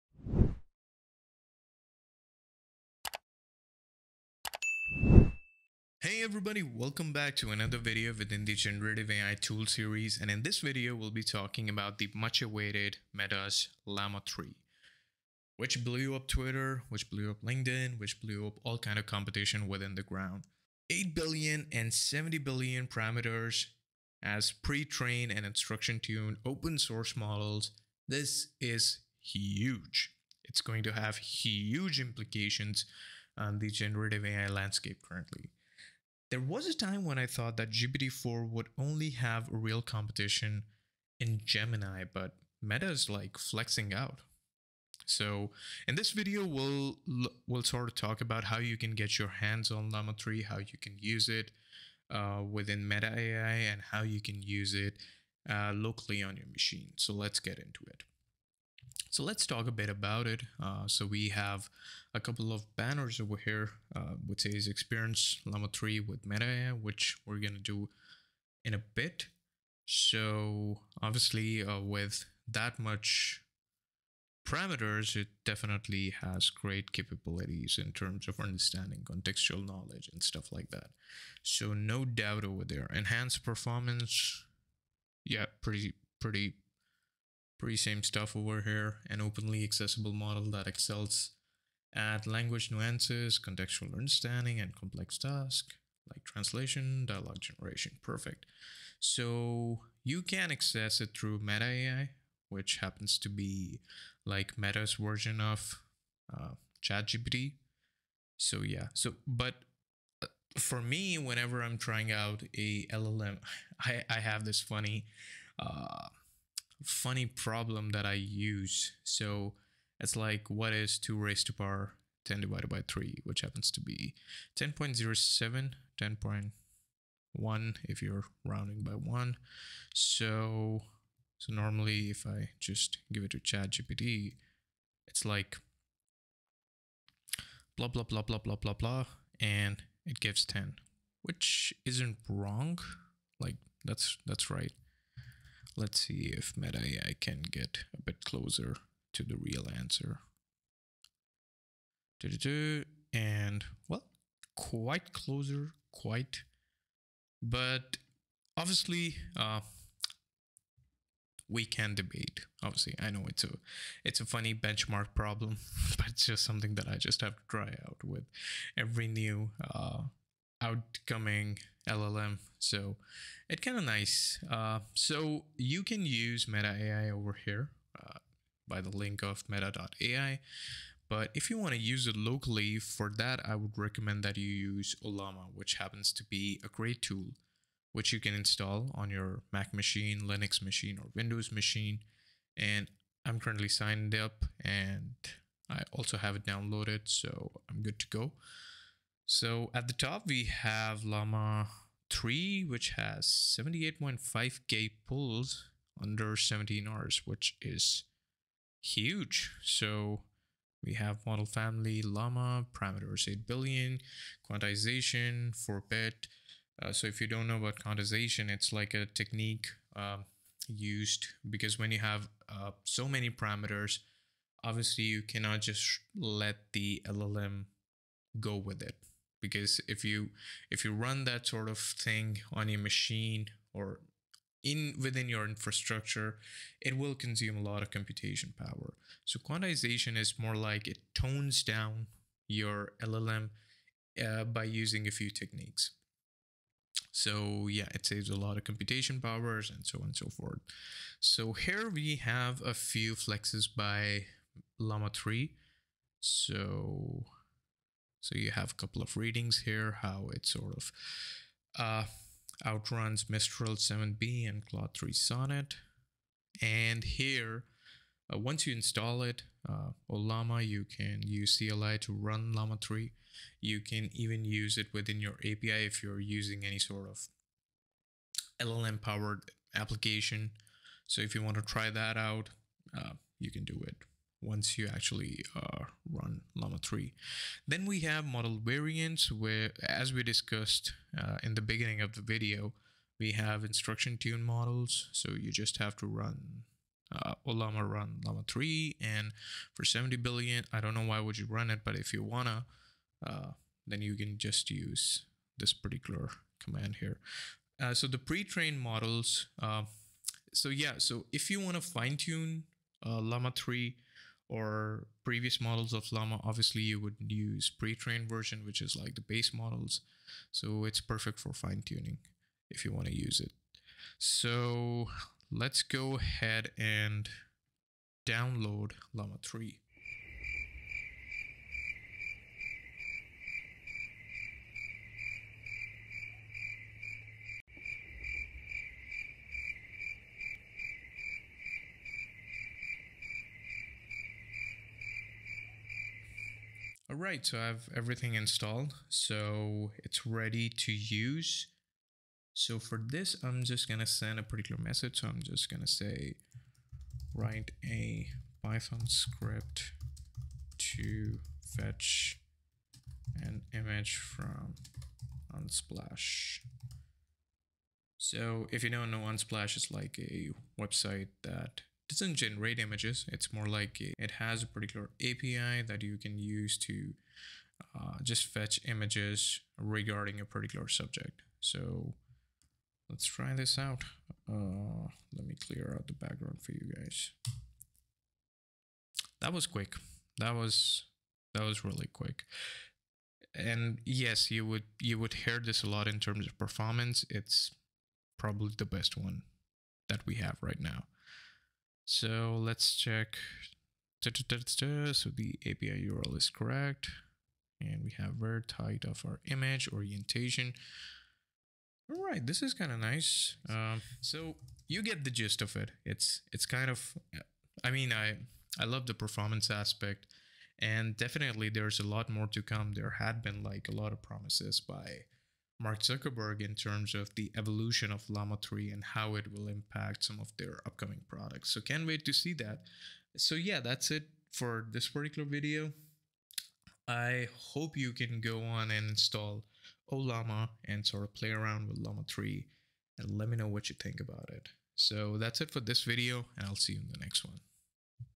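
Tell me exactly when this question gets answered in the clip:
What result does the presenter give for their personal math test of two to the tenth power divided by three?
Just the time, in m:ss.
2:04.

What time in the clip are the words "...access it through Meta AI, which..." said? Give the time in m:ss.
1:40.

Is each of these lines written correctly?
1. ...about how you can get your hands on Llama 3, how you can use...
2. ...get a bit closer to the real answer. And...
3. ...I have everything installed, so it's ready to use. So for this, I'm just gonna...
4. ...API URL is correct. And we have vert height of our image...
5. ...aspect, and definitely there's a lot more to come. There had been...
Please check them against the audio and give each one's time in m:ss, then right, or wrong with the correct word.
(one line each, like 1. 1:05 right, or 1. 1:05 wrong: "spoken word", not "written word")
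1. 0:48 right
2. 2:27 right
3. 5:47 right
4. 6:45 right
5. 6:59 right.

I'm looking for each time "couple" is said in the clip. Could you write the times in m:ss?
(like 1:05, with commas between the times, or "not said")
1:02, 4:18.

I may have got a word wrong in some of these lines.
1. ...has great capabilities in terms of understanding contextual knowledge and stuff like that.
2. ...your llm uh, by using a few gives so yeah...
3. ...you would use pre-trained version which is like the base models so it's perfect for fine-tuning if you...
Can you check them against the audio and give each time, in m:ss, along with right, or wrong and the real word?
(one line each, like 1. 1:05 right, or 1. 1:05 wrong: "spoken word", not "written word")
1. 1:16 right
2. 4:02 wrong: "techniques", not "gives"
3. 5:16 right.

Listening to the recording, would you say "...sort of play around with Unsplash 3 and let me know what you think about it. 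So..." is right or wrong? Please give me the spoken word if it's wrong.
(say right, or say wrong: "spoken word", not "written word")
wrong: "Llama", not "Unsplash".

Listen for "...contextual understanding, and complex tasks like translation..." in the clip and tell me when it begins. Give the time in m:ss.
1:33.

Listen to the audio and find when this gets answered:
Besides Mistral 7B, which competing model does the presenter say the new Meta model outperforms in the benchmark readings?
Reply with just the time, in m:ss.
4:24.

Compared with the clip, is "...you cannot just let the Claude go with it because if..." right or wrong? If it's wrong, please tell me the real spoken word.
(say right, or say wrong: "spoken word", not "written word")
wrong: "LLM", not "Claude".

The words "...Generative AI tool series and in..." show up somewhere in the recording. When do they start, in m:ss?
0:08.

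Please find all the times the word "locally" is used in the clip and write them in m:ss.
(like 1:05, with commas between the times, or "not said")
0:55, 3:02.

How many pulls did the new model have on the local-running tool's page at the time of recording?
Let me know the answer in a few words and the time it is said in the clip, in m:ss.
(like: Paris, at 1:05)
78.5k, at 3:23.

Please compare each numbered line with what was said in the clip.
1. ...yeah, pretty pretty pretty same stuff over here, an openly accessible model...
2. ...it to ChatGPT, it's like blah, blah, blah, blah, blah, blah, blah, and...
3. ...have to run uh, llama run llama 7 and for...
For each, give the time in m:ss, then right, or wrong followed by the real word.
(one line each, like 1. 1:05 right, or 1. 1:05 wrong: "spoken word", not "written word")
1. 1:25 right
2. 2:13 right
3. 4:55 wrong: "3", not "7".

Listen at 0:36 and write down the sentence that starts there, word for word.
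There was a time when I thought that GPT-4 would only have real competition in Gemini, but Meta is like flexing out.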